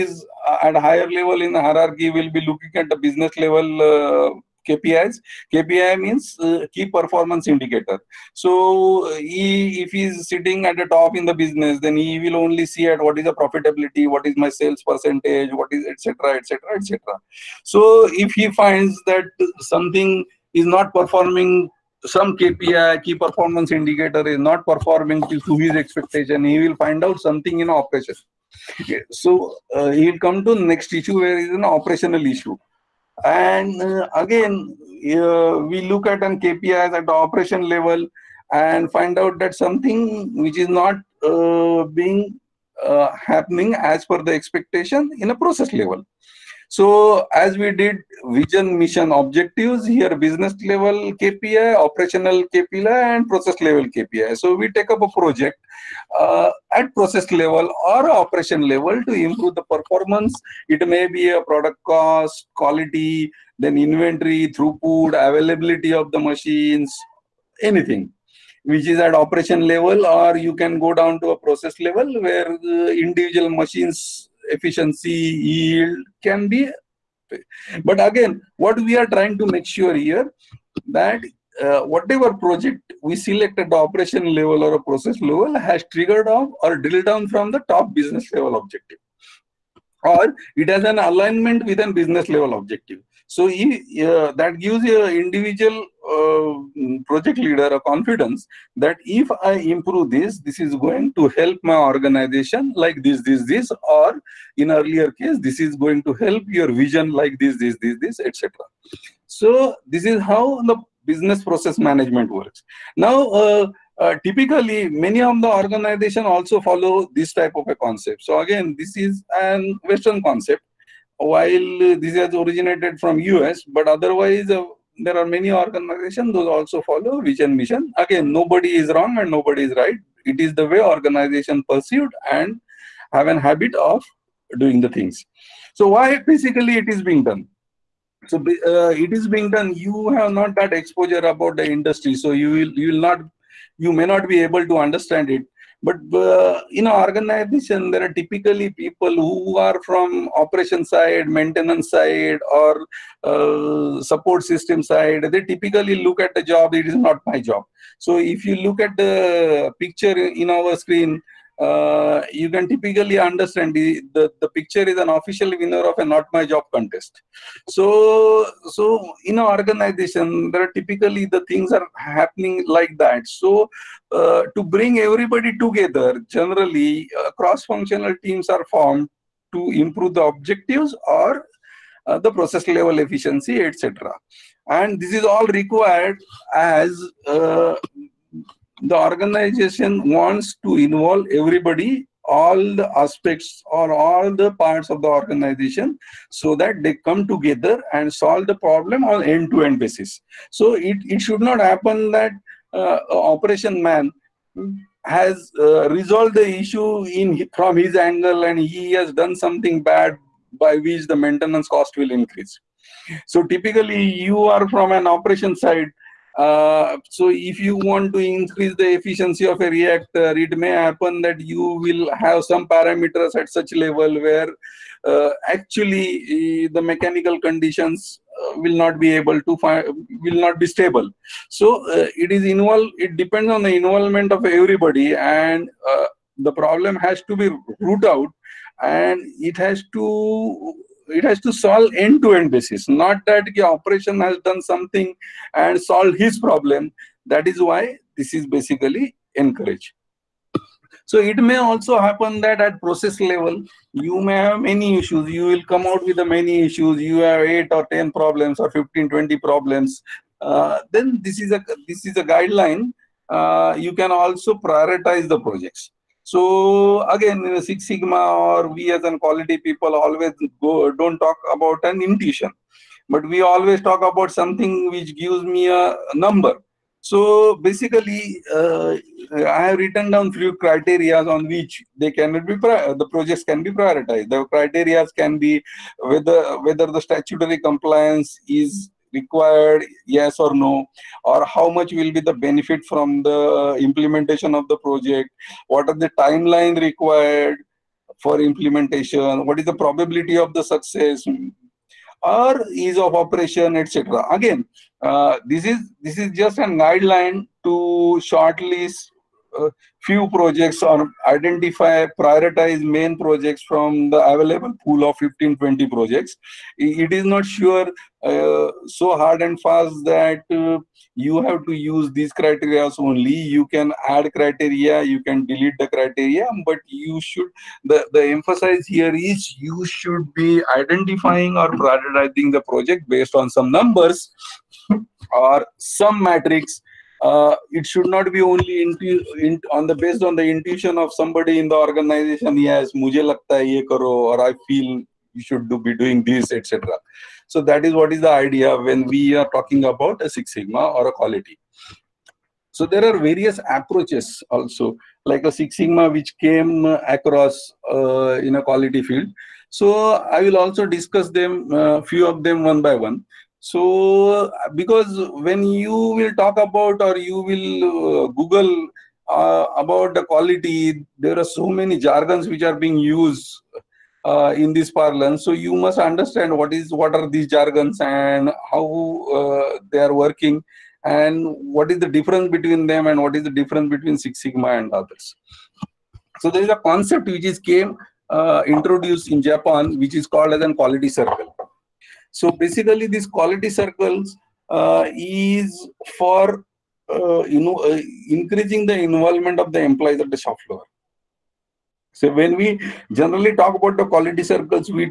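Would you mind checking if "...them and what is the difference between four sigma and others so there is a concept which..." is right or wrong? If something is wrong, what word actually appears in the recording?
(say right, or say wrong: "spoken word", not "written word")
wrong: "six", not "four".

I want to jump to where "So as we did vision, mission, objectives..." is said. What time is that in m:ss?
0:46.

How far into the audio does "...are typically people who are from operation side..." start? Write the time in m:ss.
2:28.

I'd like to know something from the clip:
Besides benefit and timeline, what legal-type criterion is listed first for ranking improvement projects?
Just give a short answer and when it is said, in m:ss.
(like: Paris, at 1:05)
statutory compliance, at 4:47.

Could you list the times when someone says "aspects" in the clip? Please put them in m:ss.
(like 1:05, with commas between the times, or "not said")
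3:12.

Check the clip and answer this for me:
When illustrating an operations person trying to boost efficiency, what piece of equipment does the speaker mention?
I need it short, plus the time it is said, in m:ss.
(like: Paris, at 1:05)
reactor, at 3:39.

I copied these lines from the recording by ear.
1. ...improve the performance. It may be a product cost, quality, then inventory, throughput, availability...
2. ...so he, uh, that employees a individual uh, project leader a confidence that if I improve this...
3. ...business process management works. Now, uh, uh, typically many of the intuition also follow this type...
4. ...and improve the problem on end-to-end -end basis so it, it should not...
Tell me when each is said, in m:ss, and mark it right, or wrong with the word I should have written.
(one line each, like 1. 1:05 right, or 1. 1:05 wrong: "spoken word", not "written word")
1. 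0:59 right
2. 1:33 wrong: "gives", not "employees"
3. 1:51 wrong: "organization", not "intuition"
4. 3:17 wrong: "solve", not "improve".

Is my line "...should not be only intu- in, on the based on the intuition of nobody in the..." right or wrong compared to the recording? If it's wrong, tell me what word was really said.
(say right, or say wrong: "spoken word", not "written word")
wrong: "somebody", not "nobody".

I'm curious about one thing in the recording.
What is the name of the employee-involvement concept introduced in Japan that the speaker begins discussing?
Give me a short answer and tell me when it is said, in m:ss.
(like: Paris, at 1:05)
quality circle, at 6:30.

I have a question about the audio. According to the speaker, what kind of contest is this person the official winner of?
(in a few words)
not my job contest.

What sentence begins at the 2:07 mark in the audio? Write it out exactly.
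Again, nobody is wrong and nobody is right.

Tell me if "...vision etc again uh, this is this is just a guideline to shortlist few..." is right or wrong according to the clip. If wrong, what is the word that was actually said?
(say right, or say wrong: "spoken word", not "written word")
wrong: "operation", not "vision".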